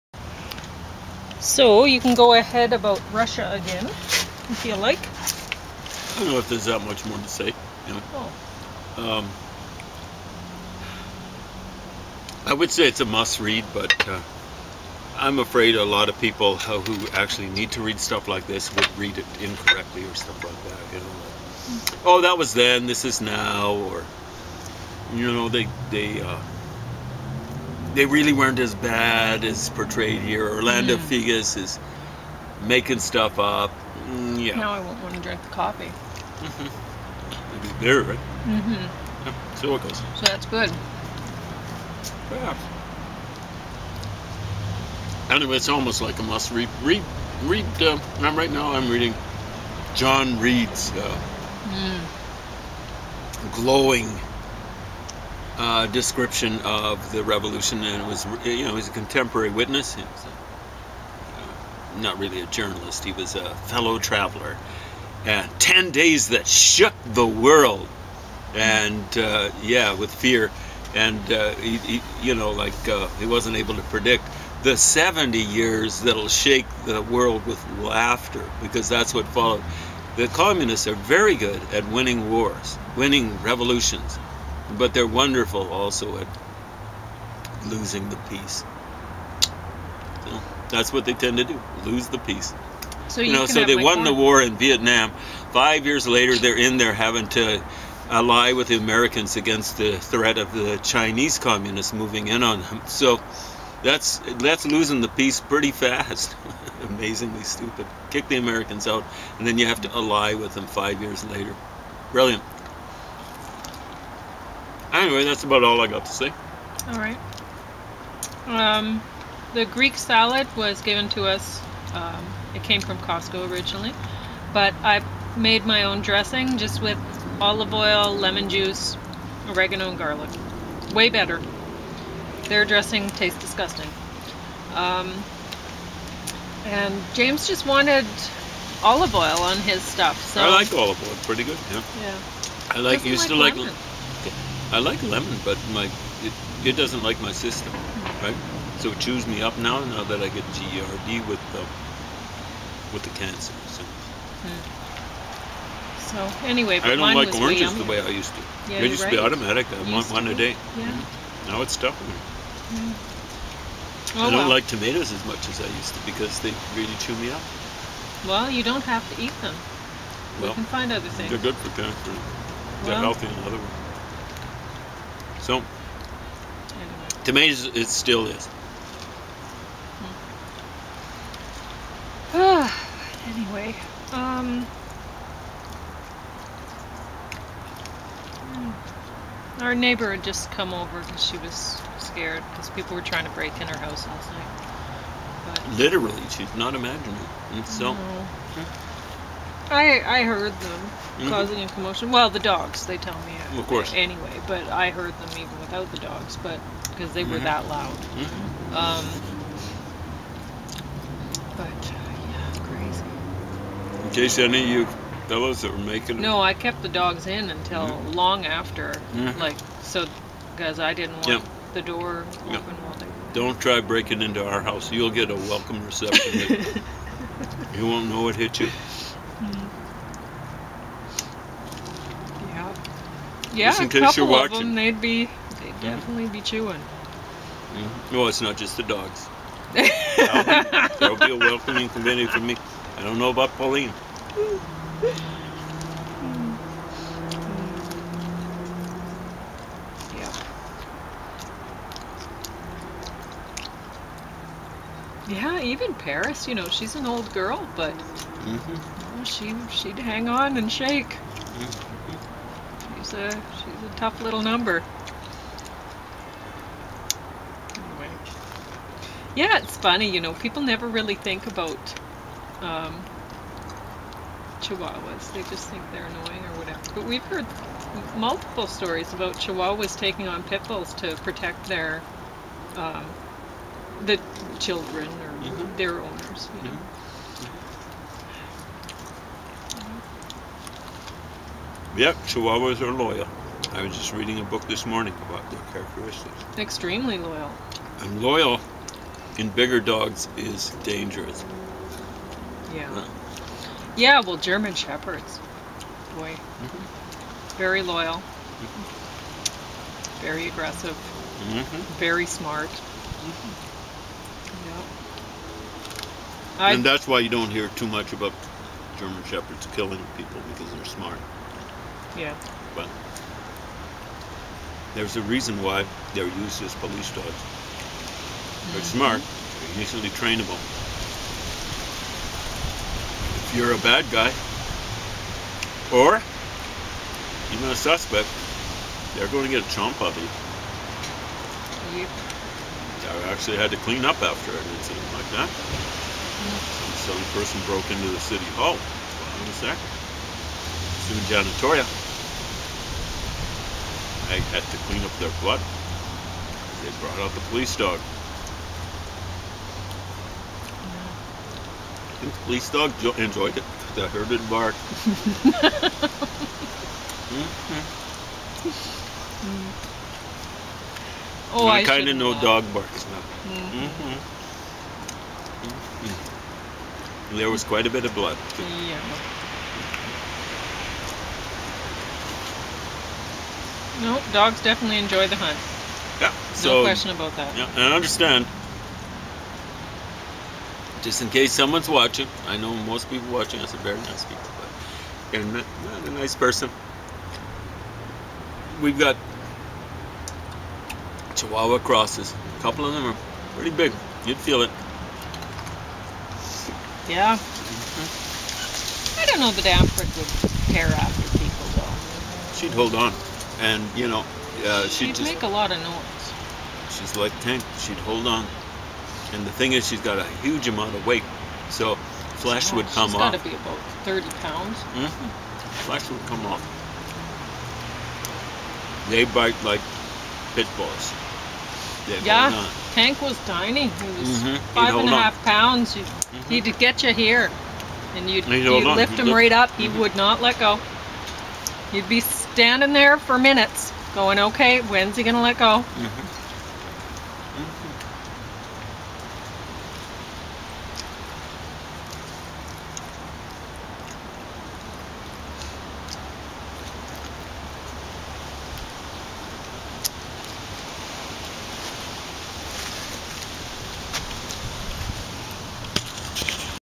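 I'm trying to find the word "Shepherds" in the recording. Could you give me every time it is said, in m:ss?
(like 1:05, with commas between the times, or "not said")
5:04, 5:19.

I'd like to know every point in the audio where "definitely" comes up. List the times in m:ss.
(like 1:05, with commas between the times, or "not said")
3:55, 6:24.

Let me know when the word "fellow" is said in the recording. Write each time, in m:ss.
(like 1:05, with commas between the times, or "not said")
1:03, 3:35.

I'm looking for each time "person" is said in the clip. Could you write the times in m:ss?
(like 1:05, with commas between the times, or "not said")
5:47, 6:36.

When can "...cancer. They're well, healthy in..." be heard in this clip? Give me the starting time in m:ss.
2:51.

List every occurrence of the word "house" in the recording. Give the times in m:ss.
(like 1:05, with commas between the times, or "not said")
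3:13, 3:44.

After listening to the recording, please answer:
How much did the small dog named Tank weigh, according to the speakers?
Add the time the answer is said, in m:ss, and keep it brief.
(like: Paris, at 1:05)
5.5 pounds, at 7:14.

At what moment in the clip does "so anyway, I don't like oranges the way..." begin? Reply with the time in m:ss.
2:36.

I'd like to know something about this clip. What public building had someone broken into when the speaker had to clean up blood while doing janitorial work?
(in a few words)
City hall.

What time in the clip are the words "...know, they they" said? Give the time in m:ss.
0:25.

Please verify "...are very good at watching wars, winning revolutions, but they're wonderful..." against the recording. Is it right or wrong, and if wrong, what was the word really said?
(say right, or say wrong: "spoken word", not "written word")
wrong: "winning", not "watching".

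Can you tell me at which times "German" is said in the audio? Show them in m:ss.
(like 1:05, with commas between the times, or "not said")
5:04, 5:18.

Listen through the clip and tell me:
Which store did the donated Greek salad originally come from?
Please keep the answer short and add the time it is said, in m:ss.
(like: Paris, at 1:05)
Costco, at 2:02.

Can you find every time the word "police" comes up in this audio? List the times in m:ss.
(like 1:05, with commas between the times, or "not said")
5:26, 5:57, 6:02.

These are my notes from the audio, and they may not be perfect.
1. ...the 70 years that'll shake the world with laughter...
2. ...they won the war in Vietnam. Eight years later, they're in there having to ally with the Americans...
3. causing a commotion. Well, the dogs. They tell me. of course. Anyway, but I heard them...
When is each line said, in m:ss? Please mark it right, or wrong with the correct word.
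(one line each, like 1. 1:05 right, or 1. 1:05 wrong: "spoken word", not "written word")
1. 1:14 right
2. 1:33 wrong: "Five", not "Eight"
3. 3:21 right.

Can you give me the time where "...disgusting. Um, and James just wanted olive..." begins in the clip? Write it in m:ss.
2:13.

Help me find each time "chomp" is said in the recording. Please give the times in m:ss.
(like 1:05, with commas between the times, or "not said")
5:39.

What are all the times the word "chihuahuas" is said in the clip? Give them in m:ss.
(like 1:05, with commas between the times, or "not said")
4:34, 4:39, 4:52, 6:41.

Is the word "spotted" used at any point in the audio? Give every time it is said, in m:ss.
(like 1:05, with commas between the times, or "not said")
not said.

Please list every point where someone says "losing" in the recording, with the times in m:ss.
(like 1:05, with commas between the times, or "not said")
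1:27, 1:44.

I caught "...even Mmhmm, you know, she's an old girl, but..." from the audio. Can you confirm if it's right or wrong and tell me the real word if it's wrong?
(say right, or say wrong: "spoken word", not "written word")
wrong: "Paris", not "Mmhmm".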